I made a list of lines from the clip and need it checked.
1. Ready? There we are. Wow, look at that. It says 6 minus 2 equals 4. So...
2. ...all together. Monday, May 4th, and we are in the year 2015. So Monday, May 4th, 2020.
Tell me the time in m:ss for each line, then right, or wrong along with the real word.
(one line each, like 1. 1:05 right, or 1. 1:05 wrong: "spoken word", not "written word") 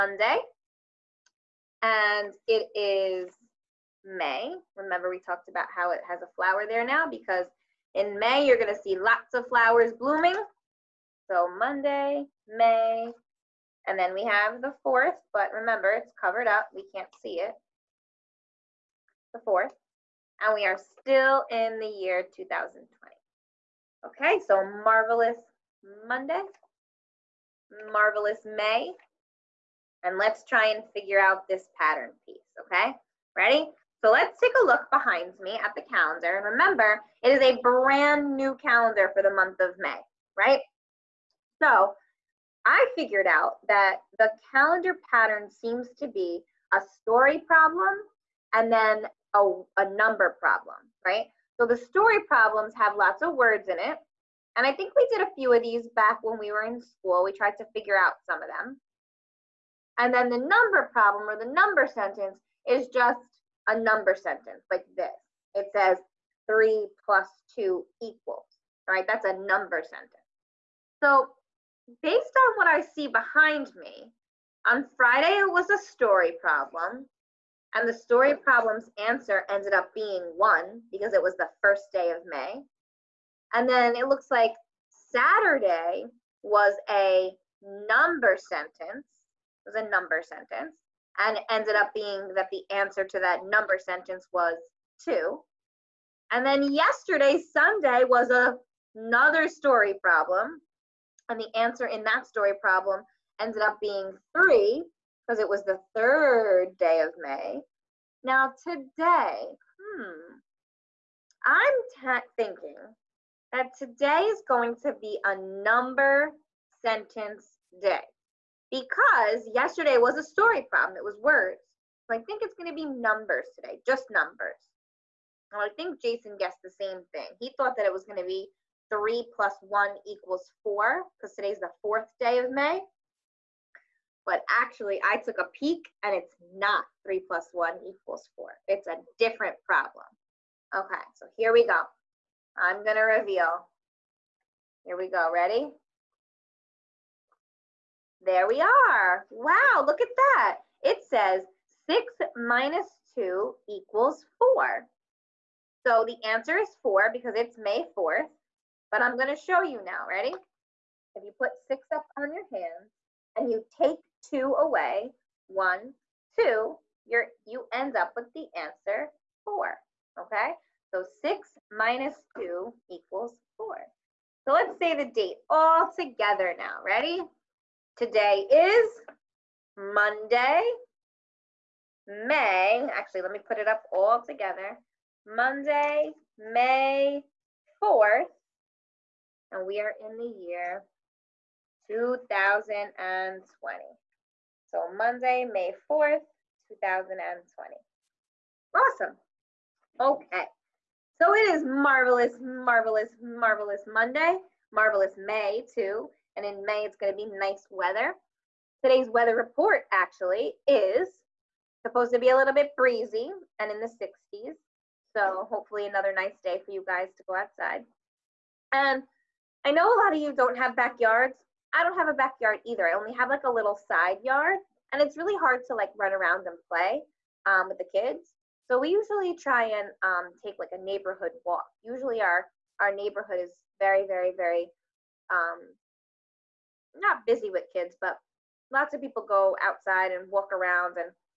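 1. 2:25 right
2. 3:03 wrong: "2020", not "2015".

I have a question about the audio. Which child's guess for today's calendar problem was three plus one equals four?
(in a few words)
Jason.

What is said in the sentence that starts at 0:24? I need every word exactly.
Okay, so marvelous Monday, marvelous May, and let's try and figure out this pattern piece, okay?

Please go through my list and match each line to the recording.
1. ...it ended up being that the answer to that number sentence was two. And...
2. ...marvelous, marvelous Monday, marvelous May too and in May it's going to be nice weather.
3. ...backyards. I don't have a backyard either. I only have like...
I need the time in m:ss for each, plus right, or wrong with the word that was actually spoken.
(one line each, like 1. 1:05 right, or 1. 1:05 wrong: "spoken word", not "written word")
1. 1:31 right
2. 3:22 right
3. 3:40 right.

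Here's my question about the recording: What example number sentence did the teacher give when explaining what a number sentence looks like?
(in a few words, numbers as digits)
3 + 2 =.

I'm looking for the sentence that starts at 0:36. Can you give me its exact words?
And remember, it is a brand new calendar for the month of May, right?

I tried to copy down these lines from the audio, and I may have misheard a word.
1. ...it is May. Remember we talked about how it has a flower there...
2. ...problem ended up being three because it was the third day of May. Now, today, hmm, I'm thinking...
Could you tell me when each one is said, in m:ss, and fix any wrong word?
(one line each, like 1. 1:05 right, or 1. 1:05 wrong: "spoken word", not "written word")
1. 0:02 right
2. 1:42 right.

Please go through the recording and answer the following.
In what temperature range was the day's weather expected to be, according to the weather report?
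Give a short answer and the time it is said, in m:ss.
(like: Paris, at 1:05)
60s, at 3:33.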